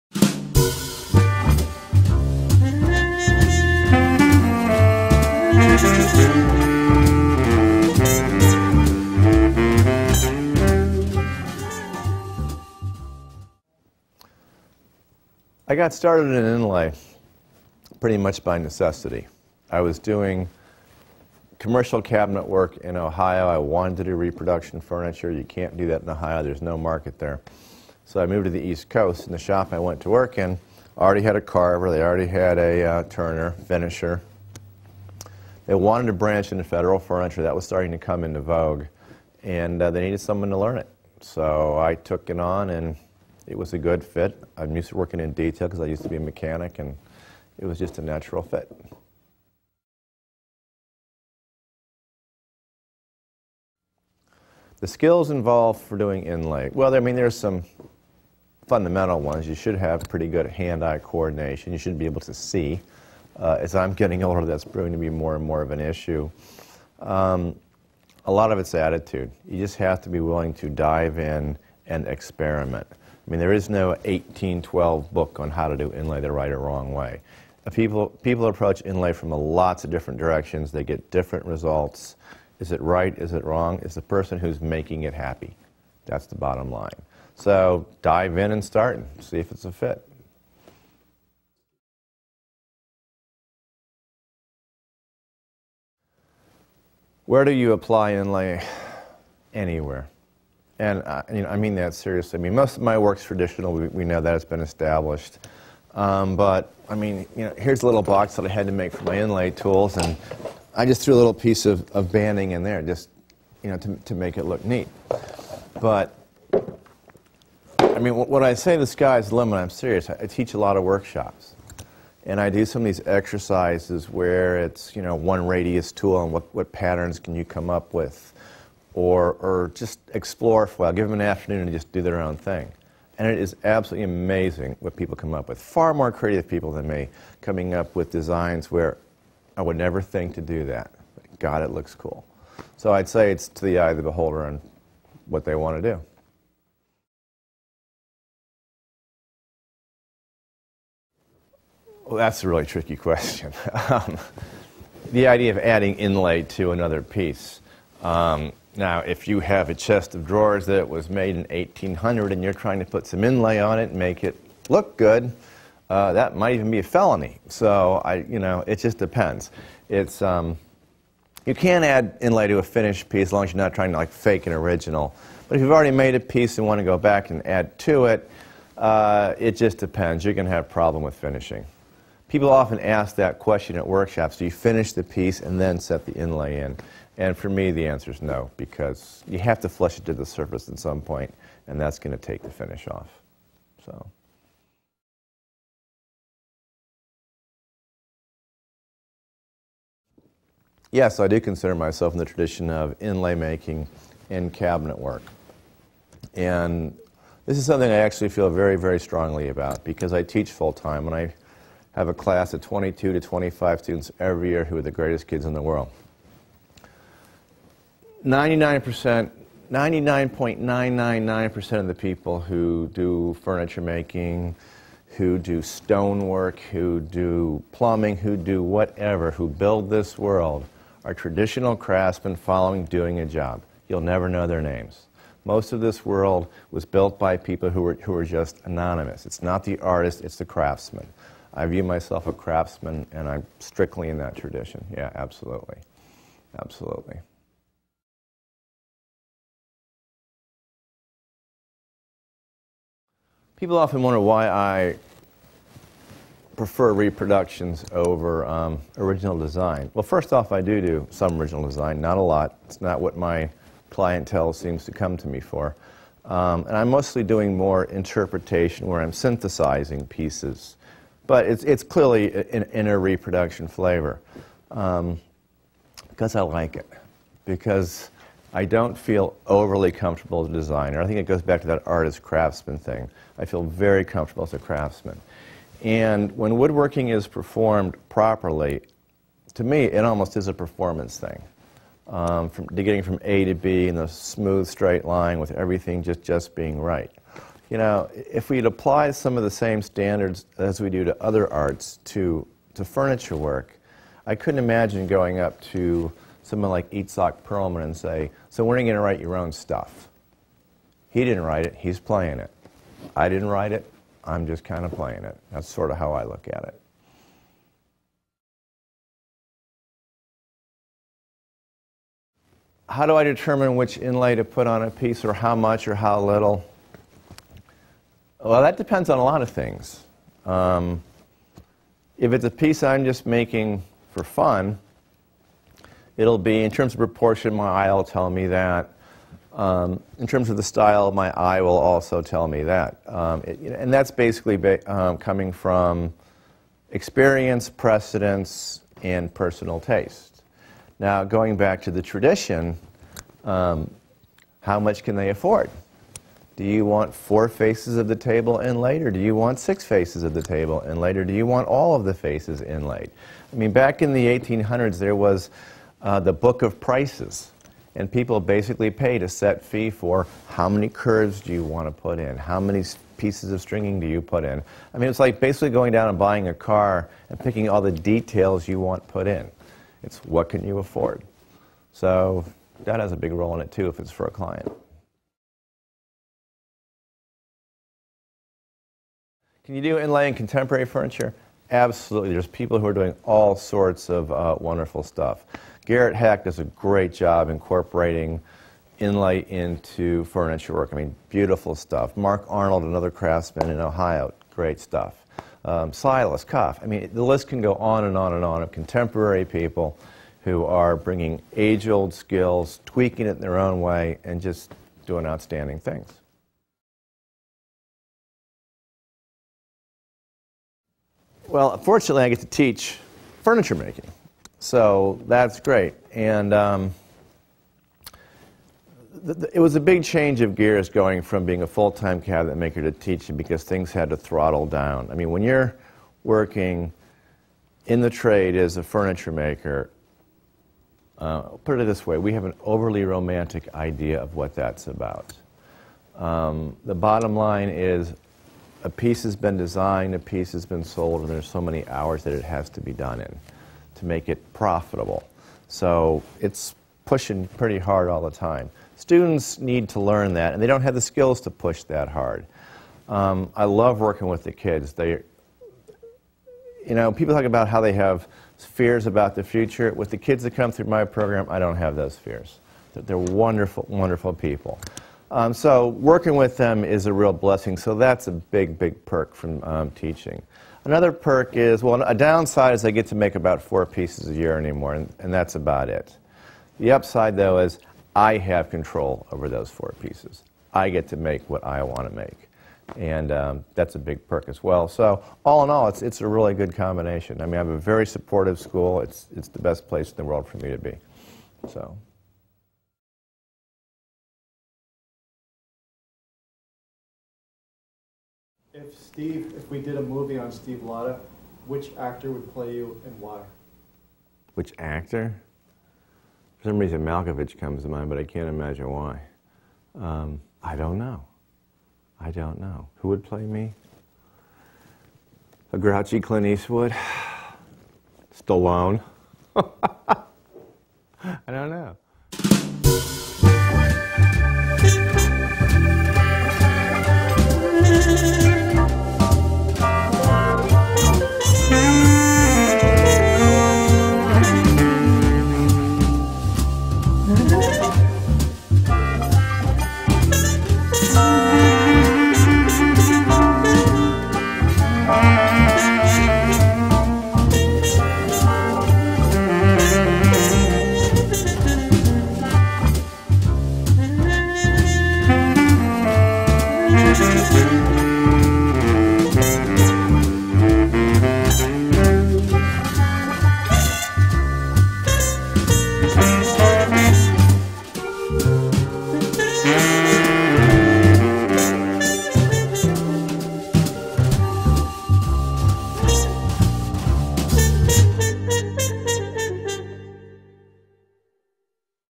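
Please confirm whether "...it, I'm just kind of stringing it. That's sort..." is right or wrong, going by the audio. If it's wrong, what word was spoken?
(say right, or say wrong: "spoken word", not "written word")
wrong: "playing", not "stringing".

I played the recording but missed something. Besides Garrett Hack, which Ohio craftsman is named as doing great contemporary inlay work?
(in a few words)
Mark Arnold.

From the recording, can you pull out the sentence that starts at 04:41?
I think it goes back to that artist craftsman thing.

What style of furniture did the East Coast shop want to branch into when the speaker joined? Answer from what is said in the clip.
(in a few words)
Federal furniture.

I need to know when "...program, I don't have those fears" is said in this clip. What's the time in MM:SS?
07:51.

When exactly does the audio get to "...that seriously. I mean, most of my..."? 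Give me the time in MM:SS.
01:41.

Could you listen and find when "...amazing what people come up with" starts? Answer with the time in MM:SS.
02:14.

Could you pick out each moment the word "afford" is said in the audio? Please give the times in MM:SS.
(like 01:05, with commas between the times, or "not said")
05:55, 06:20.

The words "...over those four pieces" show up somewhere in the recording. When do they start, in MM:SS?
08:09.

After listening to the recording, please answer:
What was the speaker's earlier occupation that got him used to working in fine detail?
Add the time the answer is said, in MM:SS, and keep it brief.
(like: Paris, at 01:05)
Mechanic, at 00:46.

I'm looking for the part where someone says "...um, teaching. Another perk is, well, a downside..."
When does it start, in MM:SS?
07:59.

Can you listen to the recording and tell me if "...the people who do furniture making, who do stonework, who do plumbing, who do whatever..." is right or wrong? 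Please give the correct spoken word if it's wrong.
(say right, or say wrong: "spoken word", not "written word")
right.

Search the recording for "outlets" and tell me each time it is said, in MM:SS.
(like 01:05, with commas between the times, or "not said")
not said.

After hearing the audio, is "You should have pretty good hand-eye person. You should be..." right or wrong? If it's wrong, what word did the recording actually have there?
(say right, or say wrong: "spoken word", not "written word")
wrong: "coordination", not "person".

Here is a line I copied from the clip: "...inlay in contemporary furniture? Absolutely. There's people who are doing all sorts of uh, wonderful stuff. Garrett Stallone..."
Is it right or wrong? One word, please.
wrong.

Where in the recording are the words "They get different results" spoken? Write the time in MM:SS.
01:20.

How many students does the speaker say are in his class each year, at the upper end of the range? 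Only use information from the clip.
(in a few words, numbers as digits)
25.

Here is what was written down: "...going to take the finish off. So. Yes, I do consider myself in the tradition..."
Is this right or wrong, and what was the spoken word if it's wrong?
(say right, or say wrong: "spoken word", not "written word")
right.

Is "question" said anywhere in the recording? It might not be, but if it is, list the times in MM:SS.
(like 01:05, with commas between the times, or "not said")
02:32, 03:03.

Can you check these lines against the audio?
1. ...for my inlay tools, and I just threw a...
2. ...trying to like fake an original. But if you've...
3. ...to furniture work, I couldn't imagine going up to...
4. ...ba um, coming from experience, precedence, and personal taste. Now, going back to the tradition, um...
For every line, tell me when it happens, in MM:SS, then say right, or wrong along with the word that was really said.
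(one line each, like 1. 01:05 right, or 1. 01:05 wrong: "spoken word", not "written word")
1. 01:48 right
2. 02:53 right
3. 05:02 right
4. 05:44 right.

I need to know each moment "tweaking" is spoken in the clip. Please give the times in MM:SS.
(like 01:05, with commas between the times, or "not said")
06:52.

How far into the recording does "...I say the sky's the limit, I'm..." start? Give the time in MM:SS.
01:58.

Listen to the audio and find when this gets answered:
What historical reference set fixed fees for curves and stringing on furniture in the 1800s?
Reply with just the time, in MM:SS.
06:06.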